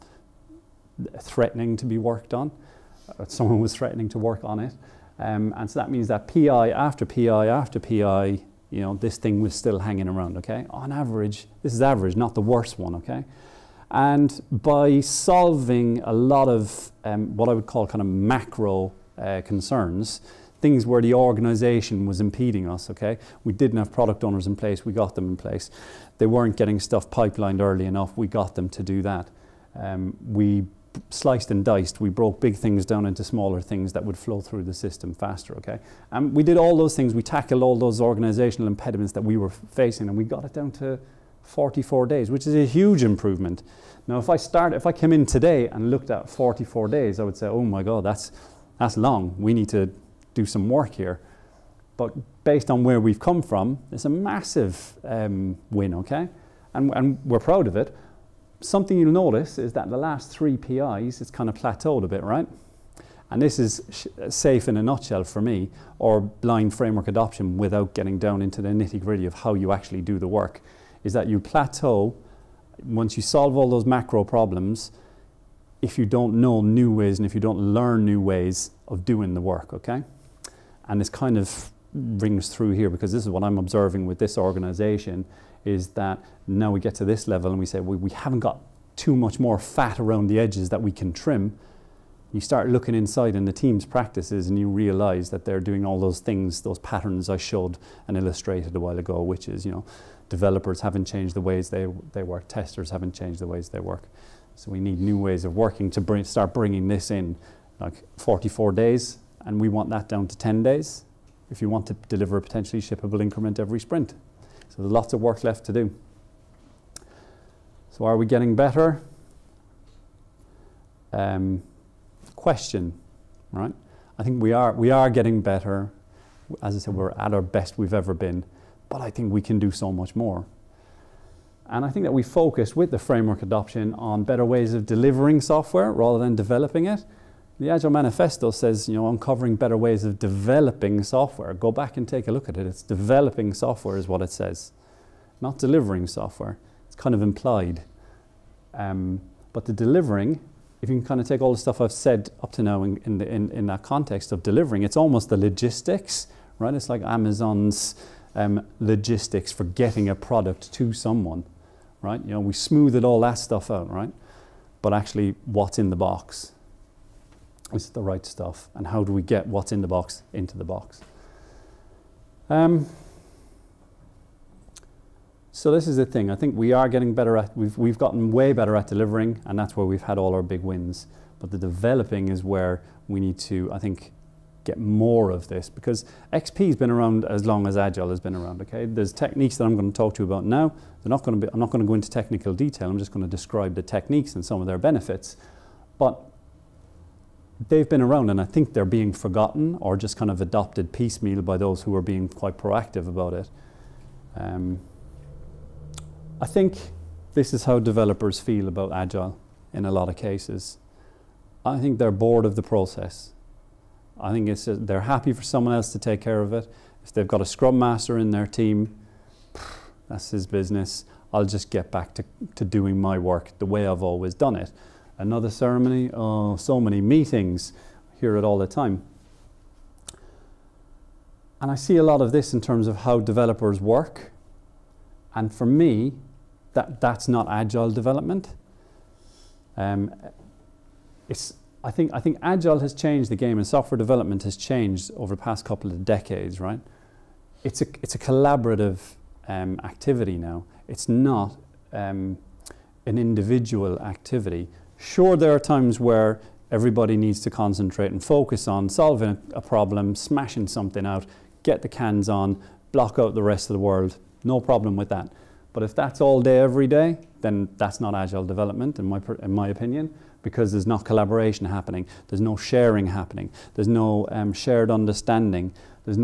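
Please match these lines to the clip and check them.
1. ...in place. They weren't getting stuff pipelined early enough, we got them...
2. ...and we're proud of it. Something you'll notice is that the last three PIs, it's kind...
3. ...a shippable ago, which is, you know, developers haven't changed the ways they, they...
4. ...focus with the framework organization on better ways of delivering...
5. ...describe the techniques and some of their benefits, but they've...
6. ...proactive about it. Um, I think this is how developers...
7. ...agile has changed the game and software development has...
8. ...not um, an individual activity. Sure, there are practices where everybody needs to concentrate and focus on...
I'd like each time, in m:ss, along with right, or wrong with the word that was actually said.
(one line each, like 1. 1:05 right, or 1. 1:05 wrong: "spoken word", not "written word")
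1. 0:25 right
2. 0:56 right
3. 1:38 wrong: "while", not "shippable"
4. 2:12 wrong: "adoption", not "organization"
5. 3:13 right
6. 3:22 right
7. 4:02 right
8. 4:11 wrong: "times", not "practices".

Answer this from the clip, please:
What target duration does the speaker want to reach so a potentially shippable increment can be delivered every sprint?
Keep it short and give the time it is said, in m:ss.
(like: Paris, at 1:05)
10 days, at 1:50.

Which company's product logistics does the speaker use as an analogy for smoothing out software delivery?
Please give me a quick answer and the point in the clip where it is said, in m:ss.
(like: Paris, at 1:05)
Amazon, at 2:37.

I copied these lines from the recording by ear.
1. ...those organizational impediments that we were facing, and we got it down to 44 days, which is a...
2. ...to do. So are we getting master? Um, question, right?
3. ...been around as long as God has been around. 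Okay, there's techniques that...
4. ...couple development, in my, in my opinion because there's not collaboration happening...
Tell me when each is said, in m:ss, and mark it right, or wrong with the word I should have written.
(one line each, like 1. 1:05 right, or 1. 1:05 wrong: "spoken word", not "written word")
1. 0:37 right
2. 1:55 wrong: "better", not "master"
3. 3:06 wrong: "Agile", not "God"
4. 4:28 wrong: "agile", not "couple".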